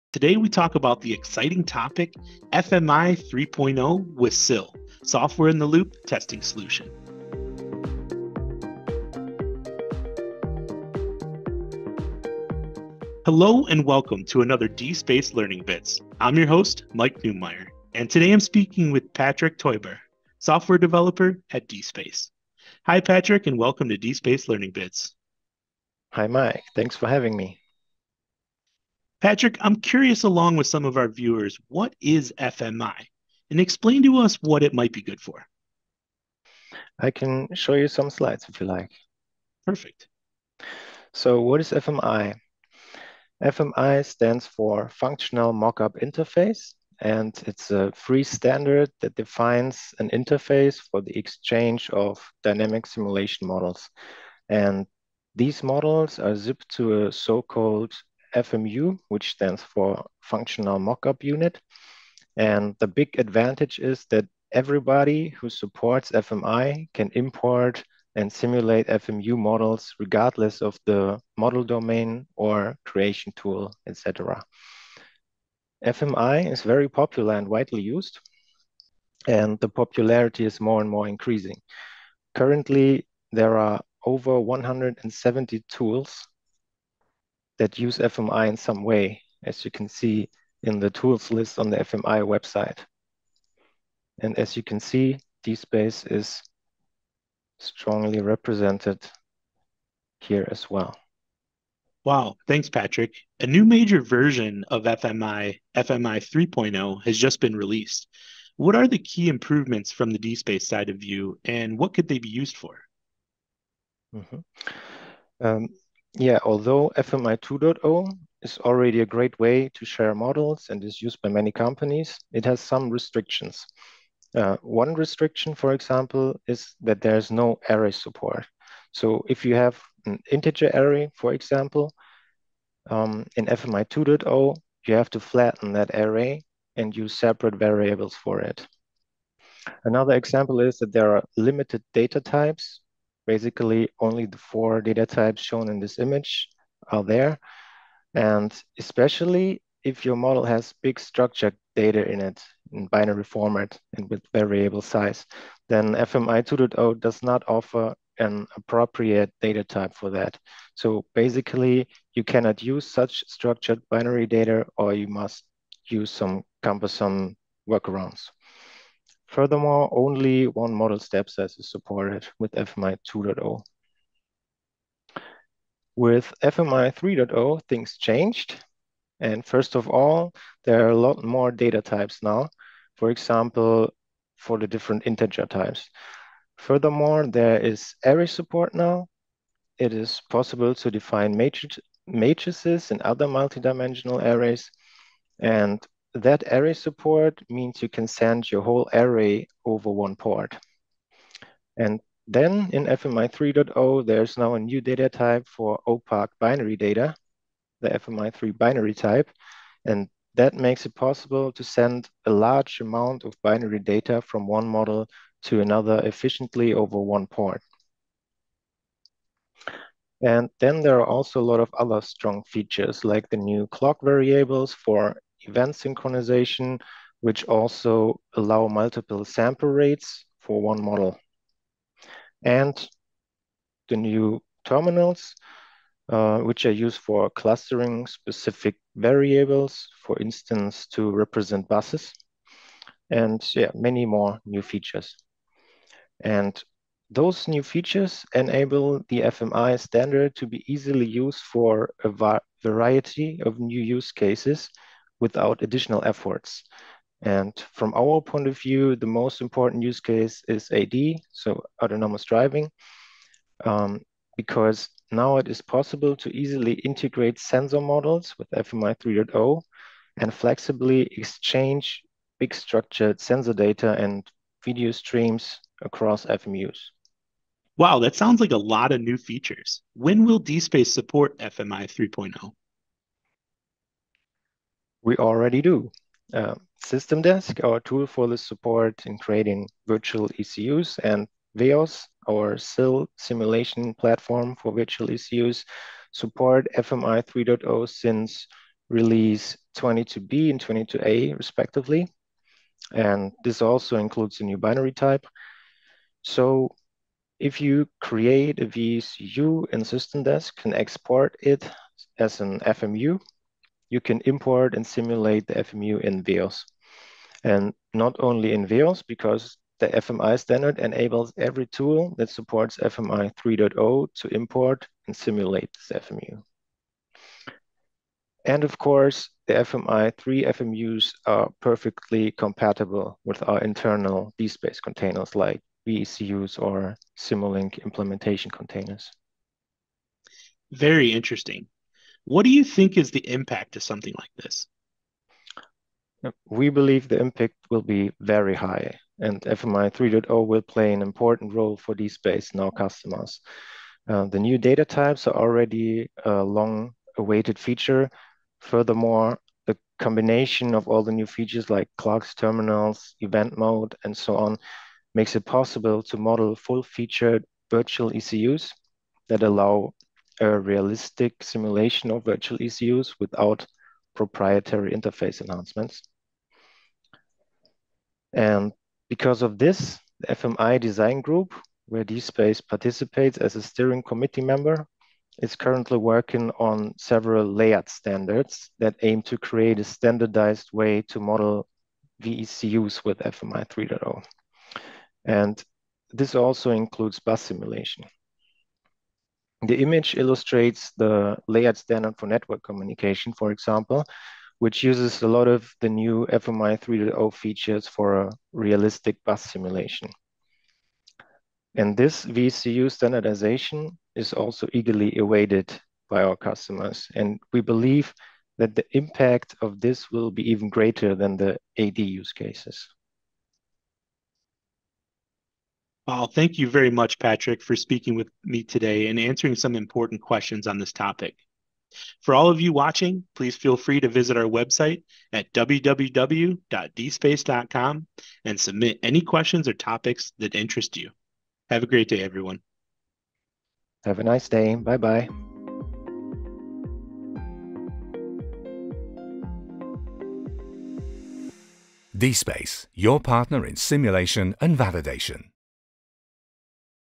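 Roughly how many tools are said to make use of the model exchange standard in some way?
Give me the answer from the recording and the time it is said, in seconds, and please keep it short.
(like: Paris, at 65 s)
over 170, at 84 s.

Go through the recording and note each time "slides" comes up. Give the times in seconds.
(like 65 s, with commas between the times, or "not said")
38 s.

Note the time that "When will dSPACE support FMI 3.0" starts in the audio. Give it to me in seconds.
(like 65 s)
279 s.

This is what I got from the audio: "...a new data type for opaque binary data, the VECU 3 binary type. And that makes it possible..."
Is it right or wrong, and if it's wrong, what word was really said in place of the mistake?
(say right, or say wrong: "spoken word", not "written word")
wrong: "FMI", not "VECU".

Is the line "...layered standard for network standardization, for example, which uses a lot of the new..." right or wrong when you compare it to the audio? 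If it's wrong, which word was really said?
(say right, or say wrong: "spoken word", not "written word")
wrong: "communication", not "standardization".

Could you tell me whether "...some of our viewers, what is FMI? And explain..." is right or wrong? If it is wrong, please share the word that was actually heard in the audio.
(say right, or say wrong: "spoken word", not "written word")
right.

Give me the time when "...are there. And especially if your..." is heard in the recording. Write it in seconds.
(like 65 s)
146 s.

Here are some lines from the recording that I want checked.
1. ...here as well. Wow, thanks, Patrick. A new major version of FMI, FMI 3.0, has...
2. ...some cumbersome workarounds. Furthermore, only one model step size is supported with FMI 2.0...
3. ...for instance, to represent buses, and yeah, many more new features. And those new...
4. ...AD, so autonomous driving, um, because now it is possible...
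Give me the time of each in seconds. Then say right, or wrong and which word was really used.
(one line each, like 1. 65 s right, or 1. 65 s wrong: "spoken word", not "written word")
1. 100 s right
2. 166 s right
3. 240 s right
4. 260 s right.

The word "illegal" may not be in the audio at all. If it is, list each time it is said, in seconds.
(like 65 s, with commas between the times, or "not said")
not said.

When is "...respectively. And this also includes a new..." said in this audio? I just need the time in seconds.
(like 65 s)
301 s.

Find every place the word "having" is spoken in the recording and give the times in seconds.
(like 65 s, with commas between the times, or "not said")
27 s.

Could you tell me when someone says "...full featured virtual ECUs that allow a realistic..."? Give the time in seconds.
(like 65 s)
366 s.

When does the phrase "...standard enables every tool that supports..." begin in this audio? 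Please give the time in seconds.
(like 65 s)
320 s.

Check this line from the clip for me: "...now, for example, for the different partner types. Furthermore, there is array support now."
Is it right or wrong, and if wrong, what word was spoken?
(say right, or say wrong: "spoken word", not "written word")
wrong: "integer", not "partner".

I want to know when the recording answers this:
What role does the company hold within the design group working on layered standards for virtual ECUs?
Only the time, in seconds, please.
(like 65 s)
383 s.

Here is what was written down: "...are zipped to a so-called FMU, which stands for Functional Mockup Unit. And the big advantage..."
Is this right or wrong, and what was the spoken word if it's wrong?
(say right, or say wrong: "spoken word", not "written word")
right.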